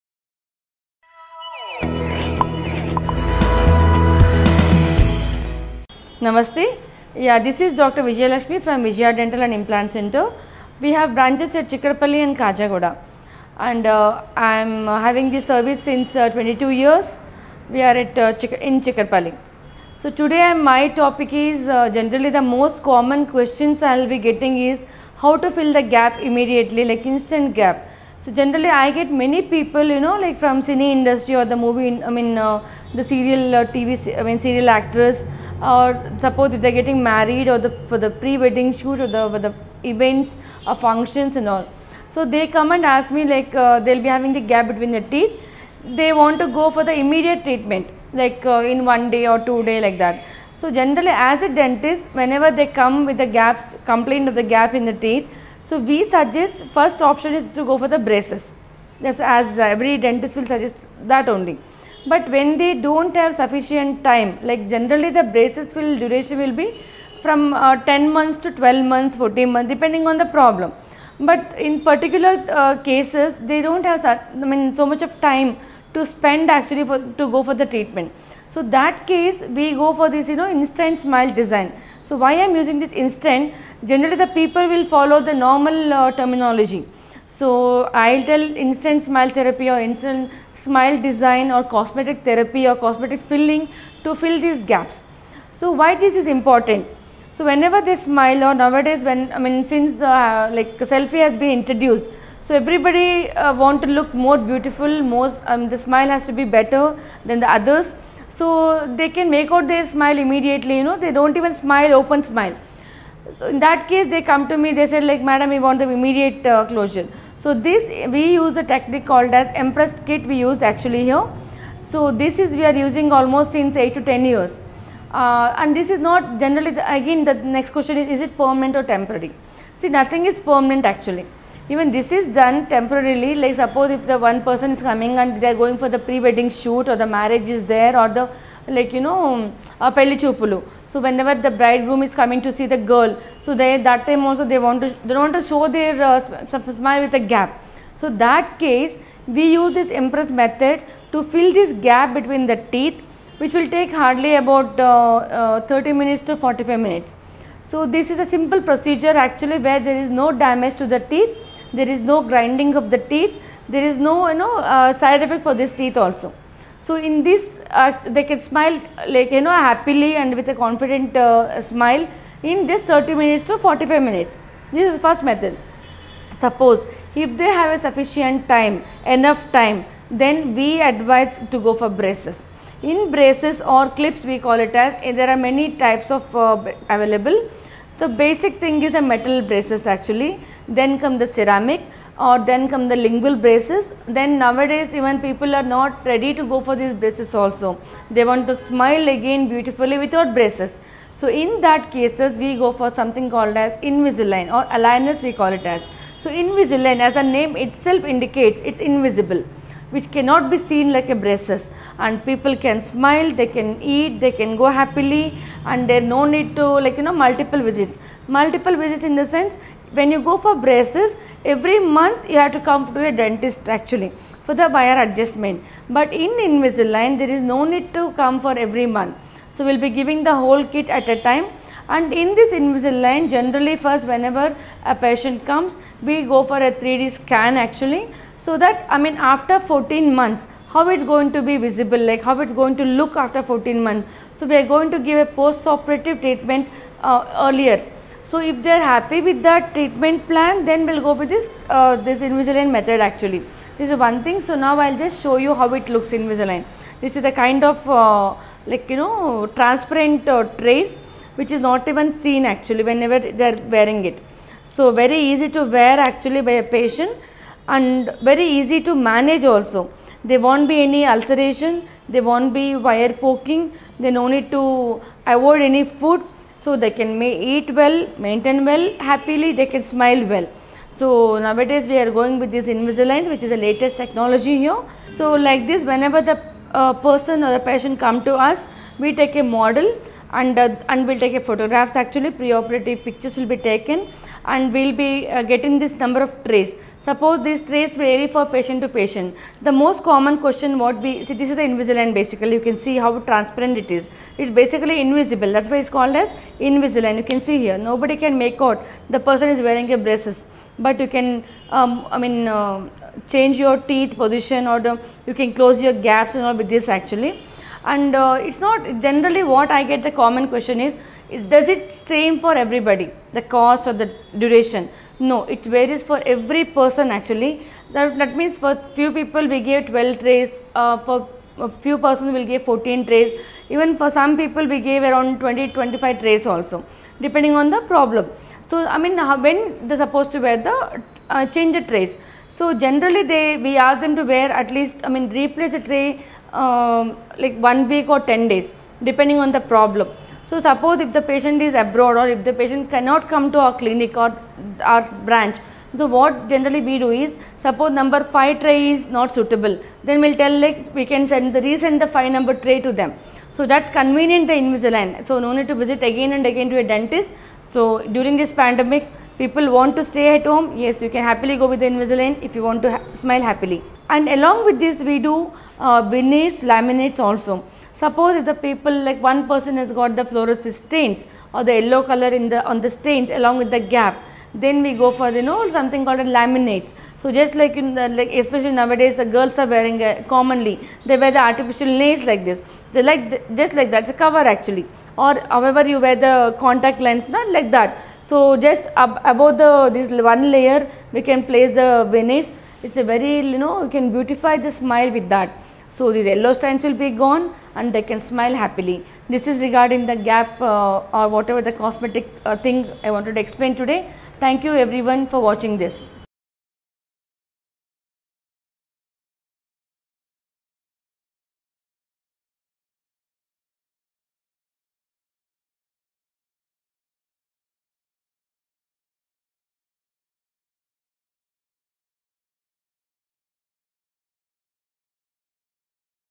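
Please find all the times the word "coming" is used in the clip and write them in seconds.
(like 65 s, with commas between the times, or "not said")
134 s, 142 s.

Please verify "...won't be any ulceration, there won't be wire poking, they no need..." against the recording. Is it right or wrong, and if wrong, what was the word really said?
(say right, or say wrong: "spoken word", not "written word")
right.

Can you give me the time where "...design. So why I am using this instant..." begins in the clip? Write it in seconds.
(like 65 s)
81 s.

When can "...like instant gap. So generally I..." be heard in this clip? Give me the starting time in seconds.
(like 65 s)
26 s.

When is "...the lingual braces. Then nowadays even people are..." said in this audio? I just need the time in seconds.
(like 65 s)
192 s.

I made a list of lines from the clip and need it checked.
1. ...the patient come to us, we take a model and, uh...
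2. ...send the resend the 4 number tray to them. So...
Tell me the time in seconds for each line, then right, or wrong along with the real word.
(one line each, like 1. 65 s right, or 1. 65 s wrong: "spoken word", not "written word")
1. 287 s right
2. 361 s wrong: "5", not "4".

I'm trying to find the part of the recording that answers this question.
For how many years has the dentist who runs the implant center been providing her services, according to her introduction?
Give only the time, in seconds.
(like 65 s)
16 s.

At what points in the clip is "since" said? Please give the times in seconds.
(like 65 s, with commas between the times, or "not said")
15 s, 99 s, 123 s.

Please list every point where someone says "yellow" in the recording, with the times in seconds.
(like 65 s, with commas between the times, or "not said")
381 s, 406 s.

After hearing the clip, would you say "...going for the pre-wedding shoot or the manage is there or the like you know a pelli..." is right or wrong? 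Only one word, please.
wrong.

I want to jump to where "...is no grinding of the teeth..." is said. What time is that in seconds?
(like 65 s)
161 s.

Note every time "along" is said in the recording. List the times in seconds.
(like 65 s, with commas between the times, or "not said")
374 s, 383 s.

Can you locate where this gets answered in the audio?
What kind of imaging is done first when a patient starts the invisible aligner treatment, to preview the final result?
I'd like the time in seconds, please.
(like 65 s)
236 s.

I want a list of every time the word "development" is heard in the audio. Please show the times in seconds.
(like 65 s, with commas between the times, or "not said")
not said.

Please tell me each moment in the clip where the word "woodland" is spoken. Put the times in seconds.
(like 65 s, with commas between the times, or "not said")
not said.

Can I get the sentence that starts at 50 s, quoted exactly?
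So generally as a dentist whenever they come with the gaps complaint of the gap in the teeth.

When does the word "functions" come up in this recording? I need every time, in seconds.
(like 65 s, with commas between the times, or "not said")
40 s.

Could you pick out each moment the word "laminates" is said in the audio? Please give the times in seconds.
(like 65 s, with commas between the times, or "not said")
376 s, 386 s.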